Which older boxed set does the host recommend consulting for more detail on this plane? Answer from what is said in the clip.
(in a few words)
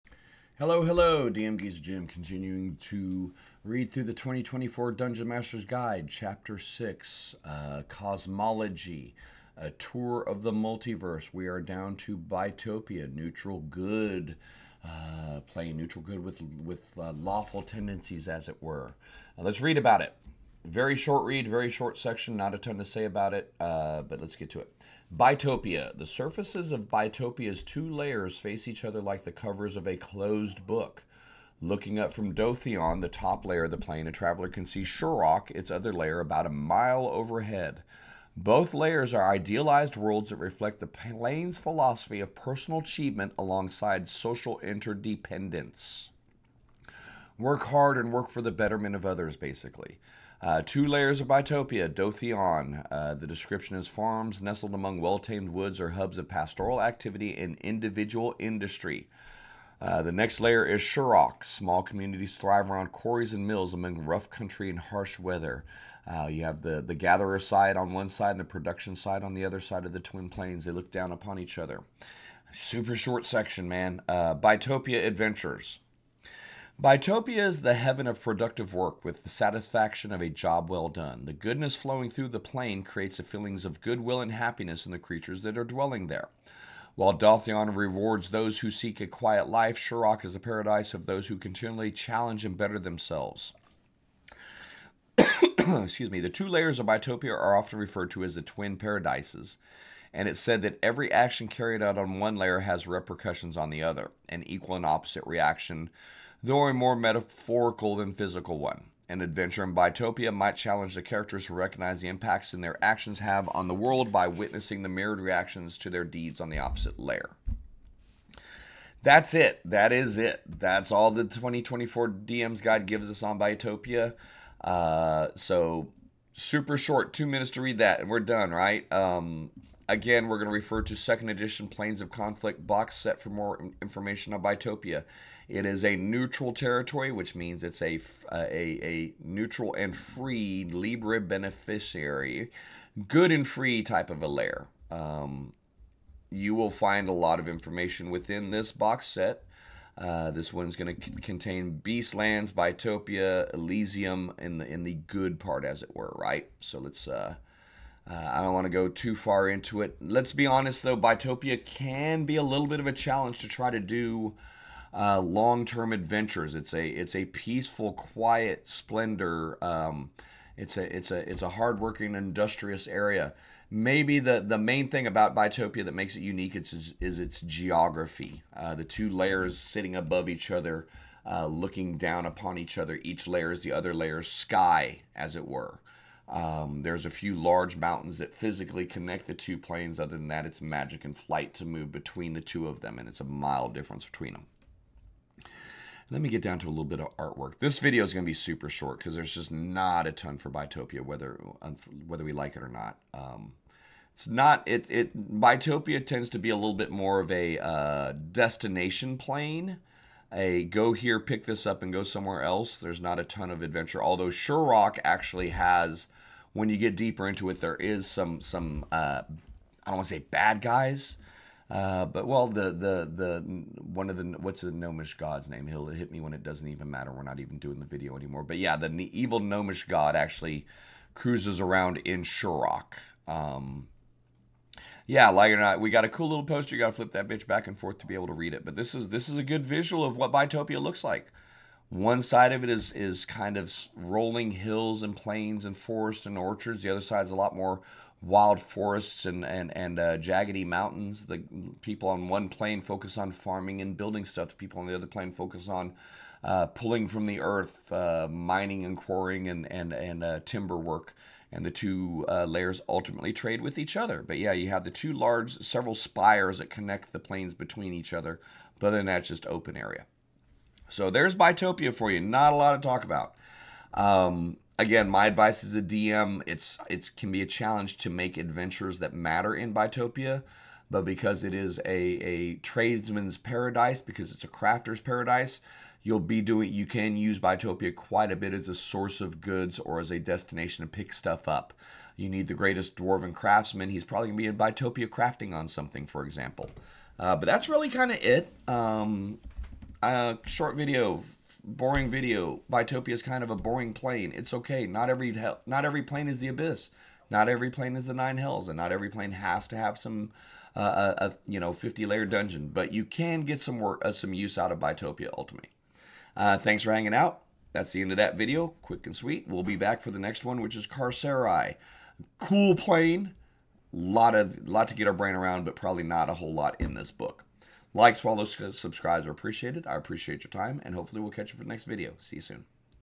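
Planes of Conflict.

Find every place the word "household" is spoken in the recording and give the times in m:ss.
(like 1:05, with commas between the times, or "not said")
not said.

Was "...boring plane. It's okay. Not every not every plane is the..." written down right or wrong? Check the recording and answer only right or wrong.
right.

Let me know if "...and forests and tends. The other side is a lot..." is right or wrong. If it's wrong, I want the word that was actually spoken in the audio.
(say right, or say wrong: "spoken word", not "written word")
wrong: "orchards", not "tends".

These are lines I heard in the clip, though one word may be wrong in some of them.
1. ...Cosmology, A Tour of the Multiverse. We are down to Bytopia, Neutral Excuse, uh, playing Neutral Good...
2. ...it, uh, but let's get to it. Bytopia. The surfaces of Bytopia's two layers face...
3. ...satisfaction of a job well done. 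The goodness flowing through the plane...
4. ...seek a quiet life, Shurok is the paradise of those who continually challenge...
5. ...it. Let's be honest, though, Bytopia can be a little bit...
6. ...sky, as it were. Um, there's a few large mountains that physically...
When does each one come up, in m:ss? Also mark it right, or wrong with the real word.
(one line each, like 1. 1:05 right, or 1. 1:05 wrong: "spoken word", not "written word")
1. 0:07 wrong: "Good", not "Excuse"
2. 0:23 right
3. 1:19 right
4. 1:28 right
5. 2:39 right
6. 3:04 right.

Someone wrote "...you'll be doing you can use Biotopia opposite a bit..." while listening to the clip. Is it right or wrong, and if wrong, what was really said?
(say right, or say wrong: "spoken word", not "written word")
wrong: "quite", not "opposite".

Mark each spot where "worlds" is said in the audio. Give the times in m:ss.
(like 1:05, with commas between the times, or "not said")
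0:39, 1:53.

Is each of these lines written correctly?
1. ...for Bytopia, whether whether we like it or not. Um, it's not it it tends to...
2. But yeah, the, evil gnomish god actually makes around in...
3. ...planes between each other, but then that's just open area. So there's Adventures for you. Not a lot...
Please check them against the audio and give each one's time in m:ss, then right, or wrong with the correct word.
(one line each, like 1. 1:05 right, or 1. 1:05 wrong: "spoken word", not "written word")
1. 3:20 right
2. 3:48 wrong: "cruises", not "makes"
3. 4:27 wrong: "Bytopia", not "Adventures".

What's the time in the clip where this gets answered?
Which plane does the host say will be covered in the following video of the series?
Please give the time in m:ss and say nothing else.
5:20.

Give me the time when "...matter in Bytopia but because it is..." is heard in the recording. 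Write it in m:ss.
4:39.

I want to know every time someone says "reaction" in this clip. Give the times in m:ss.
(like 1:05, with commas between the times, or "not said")
1:45, 1:55.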